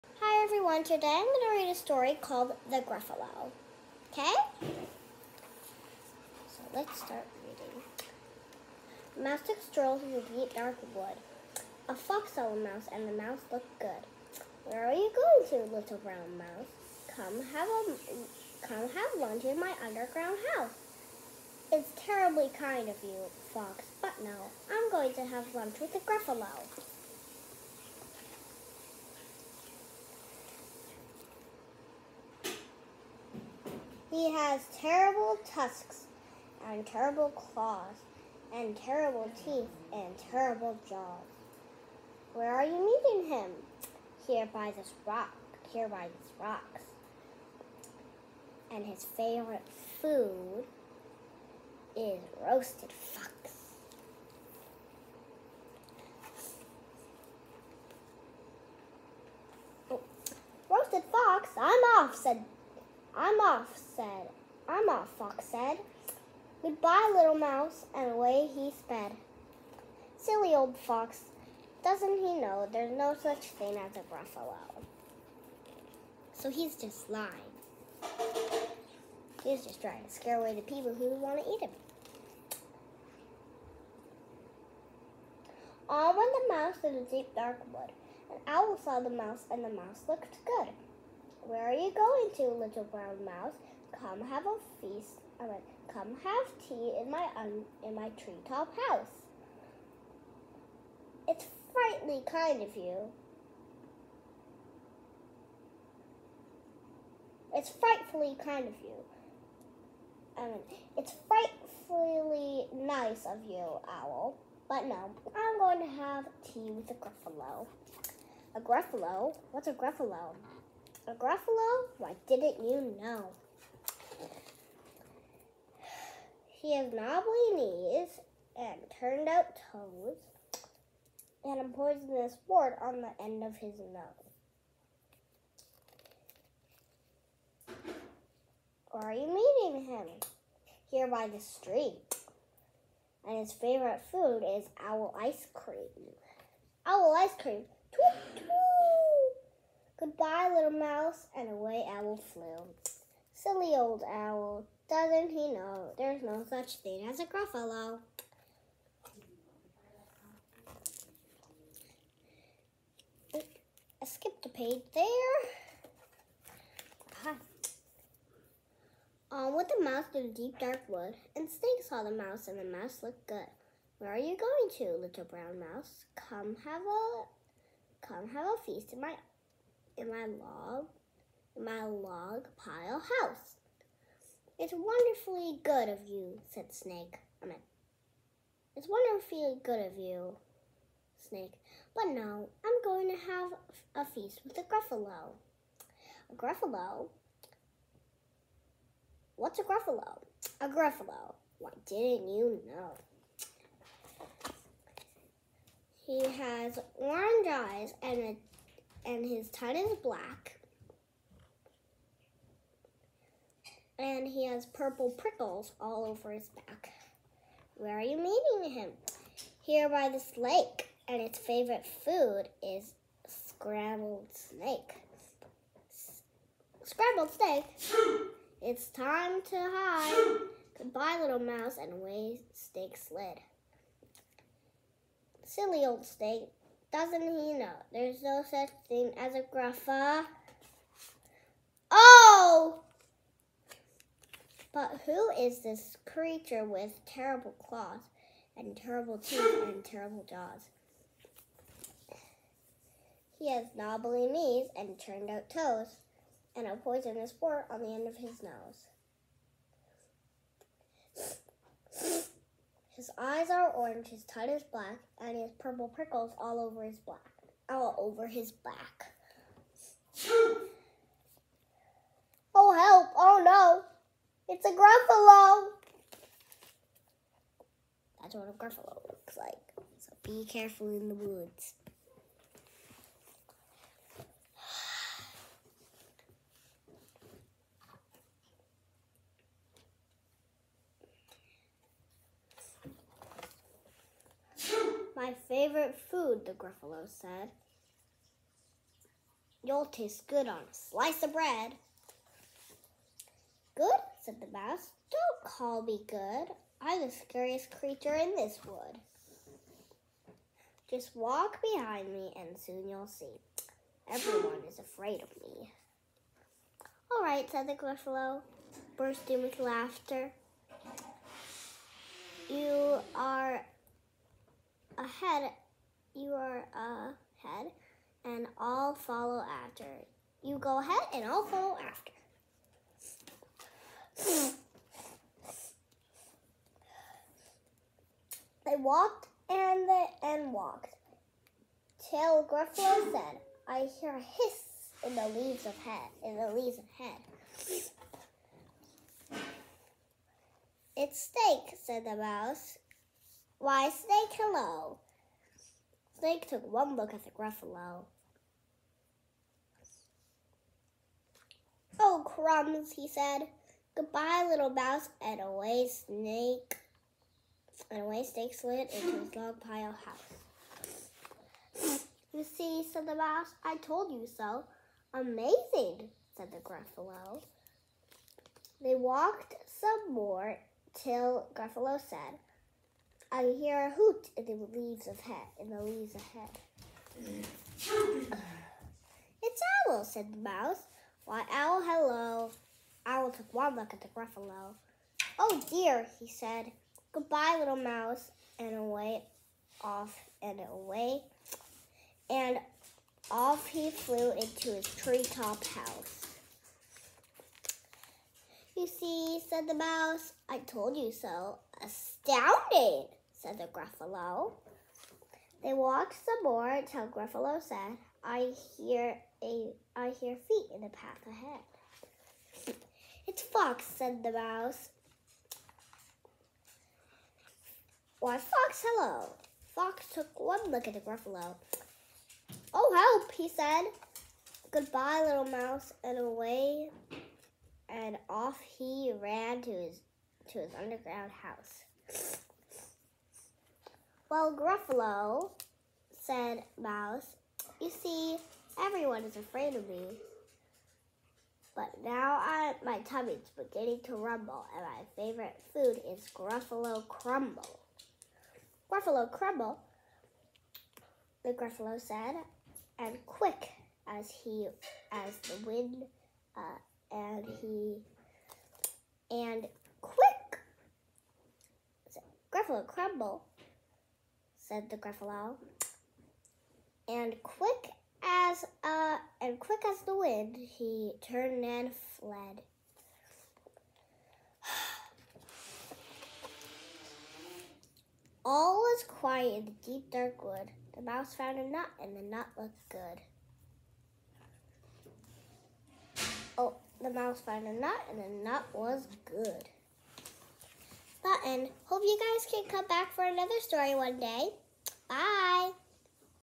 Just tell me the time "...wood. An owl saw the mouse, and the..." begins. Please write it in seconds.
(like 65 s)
87 s.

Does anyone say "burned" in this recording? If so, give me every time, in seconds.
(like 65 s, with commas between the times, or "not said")
not said.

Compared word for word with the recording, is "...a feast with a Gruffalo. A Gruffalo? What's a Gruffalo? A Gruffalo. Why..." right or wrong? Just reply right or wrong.
right.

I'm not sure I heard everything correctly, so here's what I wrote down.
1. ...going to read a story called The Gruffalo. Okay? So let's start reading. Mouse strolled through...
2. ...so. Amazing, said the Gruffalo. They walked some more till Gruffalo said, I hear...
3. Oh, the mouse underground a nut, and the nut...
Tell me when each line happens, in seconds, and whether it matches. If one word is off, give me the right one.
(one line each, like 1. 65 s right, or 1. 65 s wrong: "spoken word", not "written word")
1. 1 s right
2. 374 s right
3. 496 s wrong: "found", not "underground".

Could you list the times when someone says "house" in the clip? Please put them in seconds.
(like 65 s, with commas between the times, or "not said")
20 s, 98 s, 183 s, 370 s, 405 s, 441 s.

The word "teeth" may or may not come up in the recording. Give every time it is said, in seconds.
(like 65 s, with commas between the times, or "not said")
39 s, 249 s.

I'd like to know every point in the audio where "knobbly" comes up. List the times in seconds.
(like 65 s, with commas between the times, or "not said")
126 s, 253 s.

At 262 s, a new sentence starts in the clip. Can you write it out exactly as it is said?
His eyes are orange, his tongue is black, and he has purple prickles all over his black all over his back.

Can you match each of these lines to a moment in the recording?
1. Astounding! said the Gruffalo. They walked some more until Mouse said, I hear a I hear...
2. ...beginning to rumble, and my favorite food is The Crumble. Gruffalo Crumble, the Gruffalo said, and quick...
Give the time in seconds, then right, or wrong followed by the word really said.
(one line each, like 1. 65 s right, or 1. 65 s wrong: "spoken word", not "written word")
1. 411 s wrong: "Gruffalo", not "Mouse"
2. 453 s wrong: "Gruffalo", not "The".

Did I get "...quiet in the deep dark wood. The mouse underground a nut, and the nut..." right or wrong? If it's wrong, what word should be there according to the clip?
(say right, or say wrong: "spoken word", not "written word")
wrong: "found", not "underground".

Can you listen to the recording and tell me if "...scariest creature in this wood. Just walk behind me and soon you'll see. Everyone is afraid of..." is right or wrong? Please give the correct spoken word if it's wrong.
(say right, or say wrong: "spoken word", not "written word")
right.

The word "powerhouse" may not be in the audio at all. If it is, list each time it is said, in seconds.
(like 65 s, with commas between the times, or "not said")
not said.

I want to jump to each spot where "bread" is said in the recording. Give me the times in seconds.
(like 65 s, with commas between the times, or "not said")
301 s.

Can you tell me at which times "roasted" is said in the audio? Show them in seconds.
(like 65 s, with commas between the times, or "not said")
52 s, 60 s.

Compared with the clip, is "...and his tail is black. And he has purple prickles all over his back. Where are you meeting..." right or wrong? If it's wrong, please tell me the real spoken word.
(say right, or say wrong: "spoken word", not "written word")
right.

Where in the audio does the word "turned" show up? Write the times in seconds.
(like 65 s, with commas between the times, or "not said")
128 s, 254 s, 481 s.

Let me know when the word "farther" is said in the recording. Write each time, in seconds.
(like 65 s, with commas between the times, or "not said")
not said.